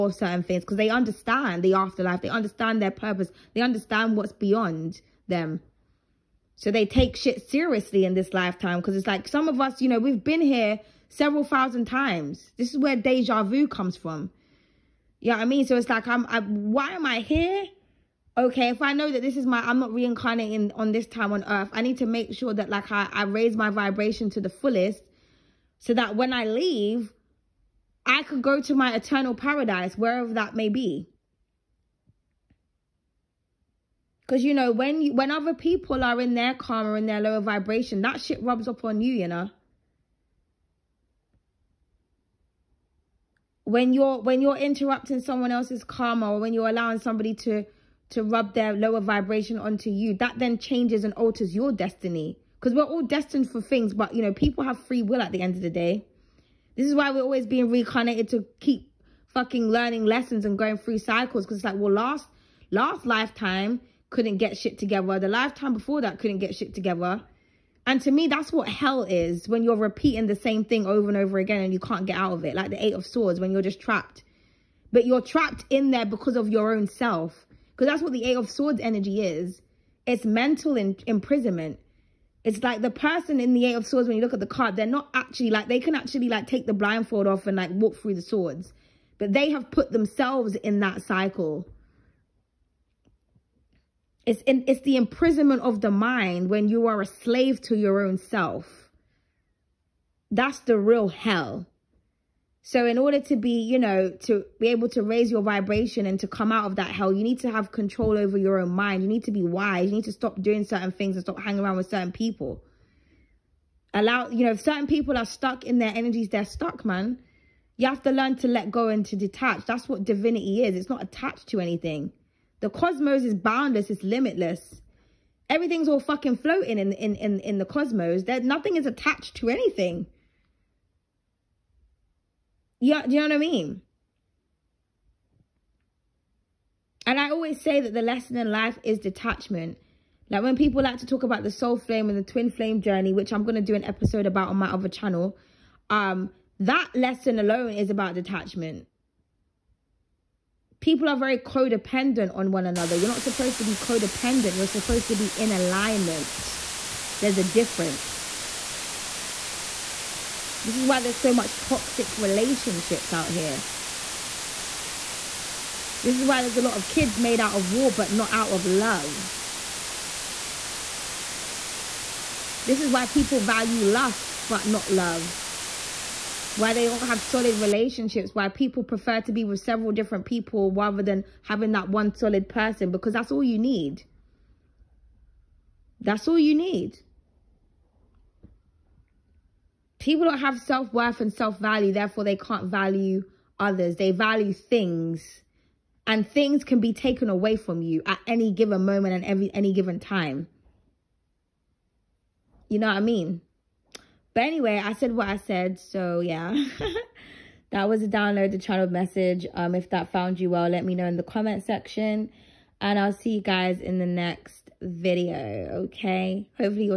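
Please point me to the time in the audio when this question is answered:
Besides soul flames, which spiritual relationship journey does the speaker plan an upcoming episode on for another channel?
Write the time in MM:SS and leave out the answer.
02:22.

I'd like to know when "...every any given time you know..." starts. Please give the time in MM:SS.
03:19.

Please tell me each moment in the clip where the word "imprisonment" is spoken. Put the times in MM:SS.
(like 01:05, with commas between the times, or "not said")
01:21, 01:34.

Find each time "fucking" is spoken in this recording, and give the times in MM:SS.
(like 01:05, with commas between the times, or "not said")
00:59, 02:06.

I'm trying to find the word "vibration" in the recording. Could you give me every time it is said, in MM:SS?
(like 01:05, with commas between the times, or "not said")
00:23, 00:37, 00:48, 01:45.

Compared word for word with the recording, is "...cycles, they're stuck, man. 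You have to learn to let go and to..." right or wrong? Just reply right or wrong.
wrong.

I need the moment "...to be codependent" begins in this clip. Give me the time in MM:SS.
02:33.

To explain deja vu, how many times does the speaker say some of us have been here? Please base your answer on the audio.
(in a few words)
Several thousand times.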